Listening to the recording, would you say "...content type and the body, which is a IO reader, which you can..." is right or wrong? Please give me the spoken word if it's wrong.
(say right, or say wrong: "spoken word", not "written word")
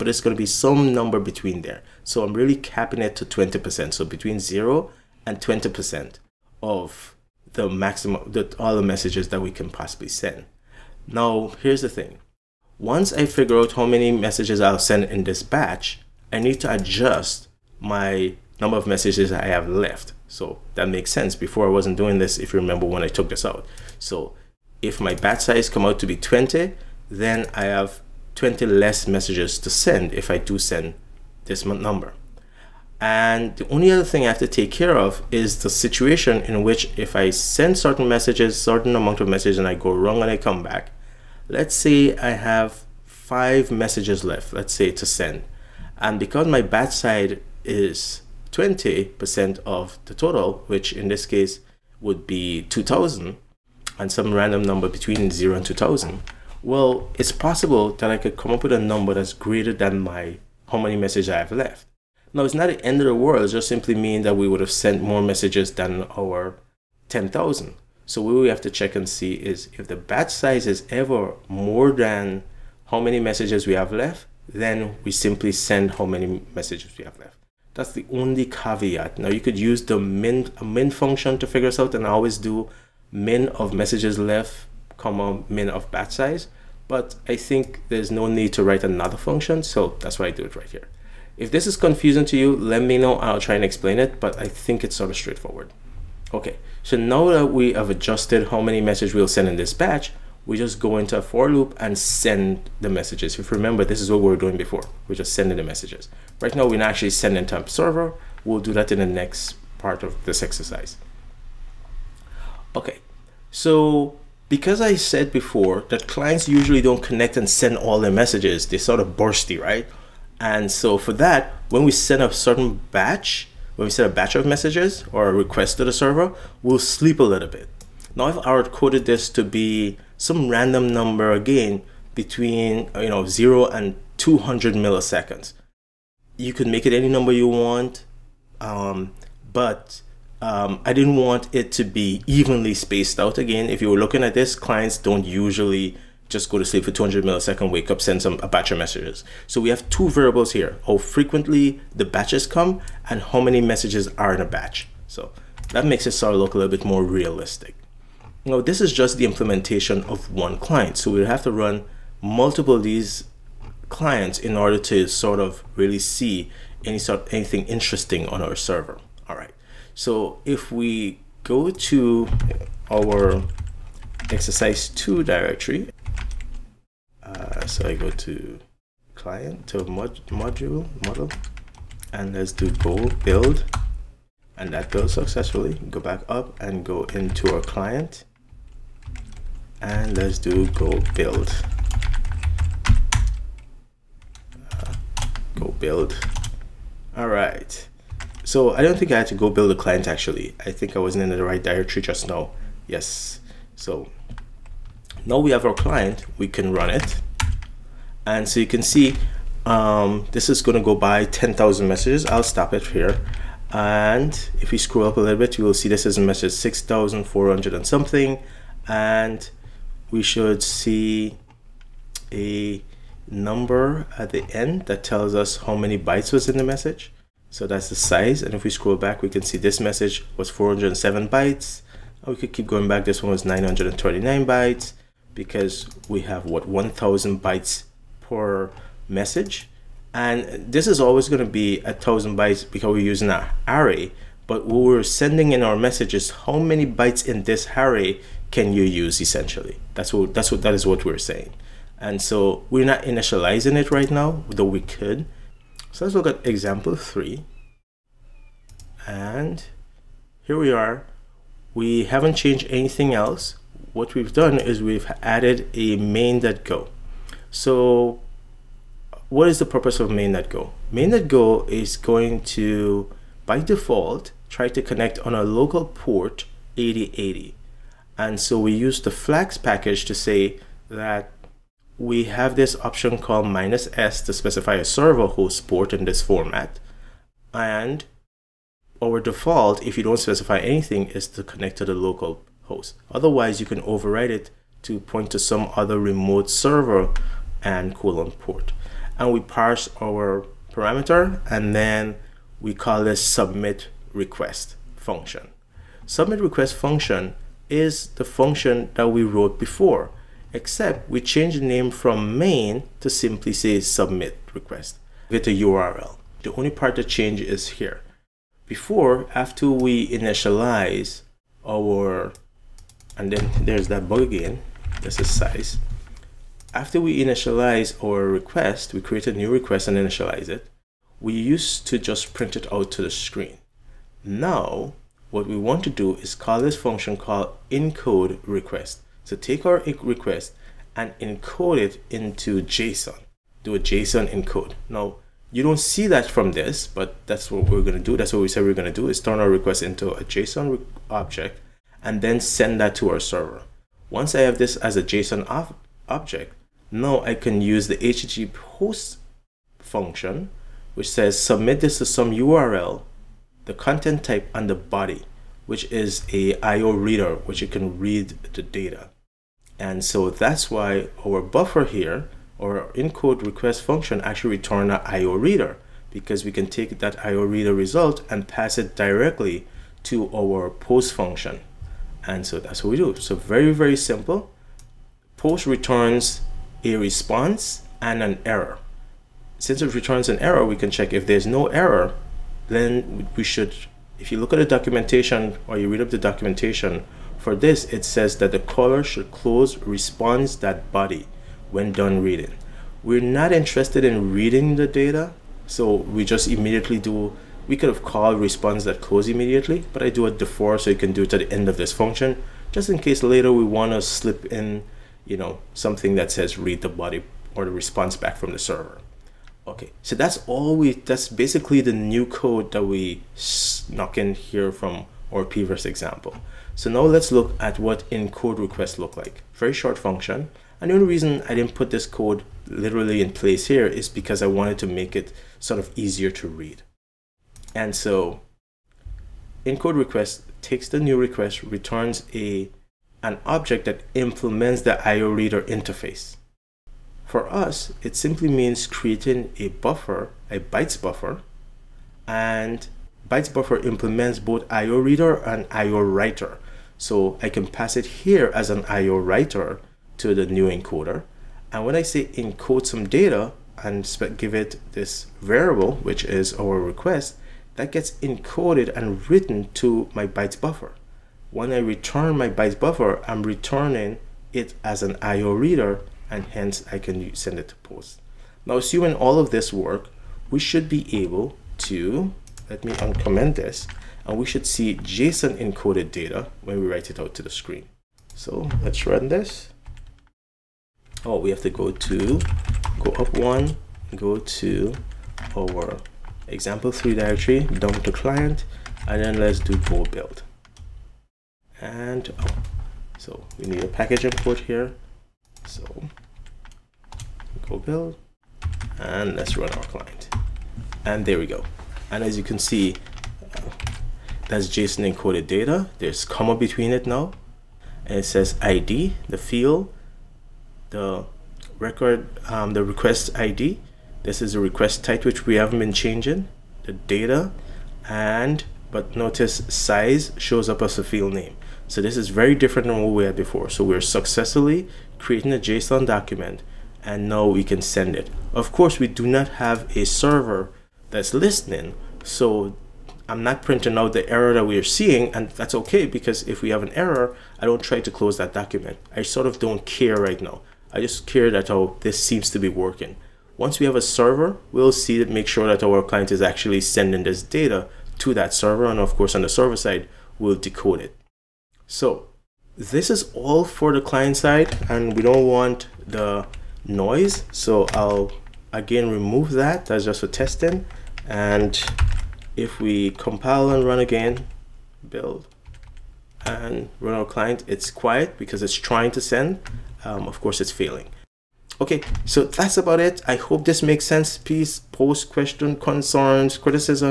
right.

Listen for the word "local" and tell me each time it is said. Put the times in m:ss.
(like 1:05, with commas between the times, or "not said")
4:35, 4:51.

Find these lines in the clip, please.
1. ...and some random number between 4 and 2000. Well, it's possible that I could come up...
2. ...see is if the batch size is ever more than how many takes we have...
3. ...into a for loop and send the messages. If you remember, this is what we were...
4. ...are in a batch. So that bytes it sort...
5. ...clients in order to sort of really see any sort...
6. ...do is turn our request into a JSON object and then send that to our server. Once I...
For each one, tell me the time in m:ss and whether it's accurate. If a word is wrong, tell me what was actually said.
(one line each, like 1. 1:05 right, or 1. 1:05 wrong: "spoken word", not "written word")
1. 0:53 wrong: "0", not "4"
2. 1:09 wrong: "messages", not "takes"
3. 1:40 right
4. 2:34 wrong: "makes", not "bytes"
5. 2:43 right
6. 5:49 right.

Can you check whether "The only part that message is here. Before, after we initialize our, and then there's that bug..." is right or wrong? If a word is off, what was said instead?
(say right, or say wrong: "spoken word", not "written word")
wrong: "change", not "message".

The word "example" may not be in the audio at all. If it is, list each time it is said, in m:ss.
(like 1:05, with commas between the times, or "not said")
4:16, 7:05, 8:16.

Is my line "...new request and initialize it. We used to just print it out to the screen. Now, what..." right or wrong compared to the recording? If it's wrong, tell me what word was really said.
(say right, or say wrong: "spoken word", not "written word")
right.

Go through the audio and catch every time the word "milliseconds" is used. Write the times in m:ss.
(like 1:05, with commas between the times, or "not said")
2:14, 2:27.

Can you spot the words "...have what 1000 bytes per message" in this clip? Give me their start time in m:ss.
3:56.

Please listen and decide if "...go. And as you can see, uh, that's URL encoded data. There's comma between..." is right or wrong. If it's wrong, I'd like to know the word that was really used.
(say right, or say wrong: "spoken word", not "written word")
wrong: "JSON", not "URL".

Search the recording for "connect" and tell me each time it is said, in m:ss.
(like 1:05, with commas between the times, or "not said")
1:57, 4:34, 4:51.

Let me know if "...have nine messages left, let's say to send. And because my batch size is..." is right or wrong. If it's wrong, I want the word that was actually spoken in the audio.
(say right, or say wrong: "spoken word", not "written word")
wrong: "five", not "nine".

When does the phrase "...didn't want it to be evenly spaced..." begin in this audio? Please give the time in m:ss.
2:20.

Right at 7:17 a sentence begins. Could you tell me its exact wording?
And so encode request takes the new request, returns a an object that implements the IO reader interface.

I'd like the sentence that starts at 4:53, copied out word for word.
Otherwise, you can override it to point to some other remote server and colon port.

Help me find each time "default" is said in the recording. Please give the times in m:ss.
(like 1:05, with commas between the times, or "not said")
4:33, 4:49.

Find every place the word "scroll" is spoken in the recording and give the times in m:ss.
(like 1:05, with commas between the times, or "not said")
3:34, 3:48.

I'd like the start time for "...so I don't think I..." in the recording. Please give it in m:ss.
3:18.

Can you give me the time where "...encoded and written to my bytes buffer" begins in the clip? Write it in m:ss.
7:48.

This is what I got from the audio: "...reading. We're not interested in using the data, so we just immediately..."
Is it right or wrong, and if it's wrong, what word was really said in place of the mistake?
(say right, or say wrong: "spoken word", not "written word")
wrong: "reading", not "using".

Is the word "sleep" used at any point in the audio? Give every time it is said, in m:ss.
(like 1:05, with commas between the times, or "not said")
2:06, 2:26.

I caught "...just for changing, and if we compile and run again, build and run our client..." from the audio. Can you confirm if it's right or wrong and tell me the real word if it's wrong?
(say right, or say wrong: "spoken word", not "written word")
wrong: "testing", not "changing".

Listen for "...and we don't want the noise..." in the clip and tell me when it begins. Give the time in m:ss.
9:24.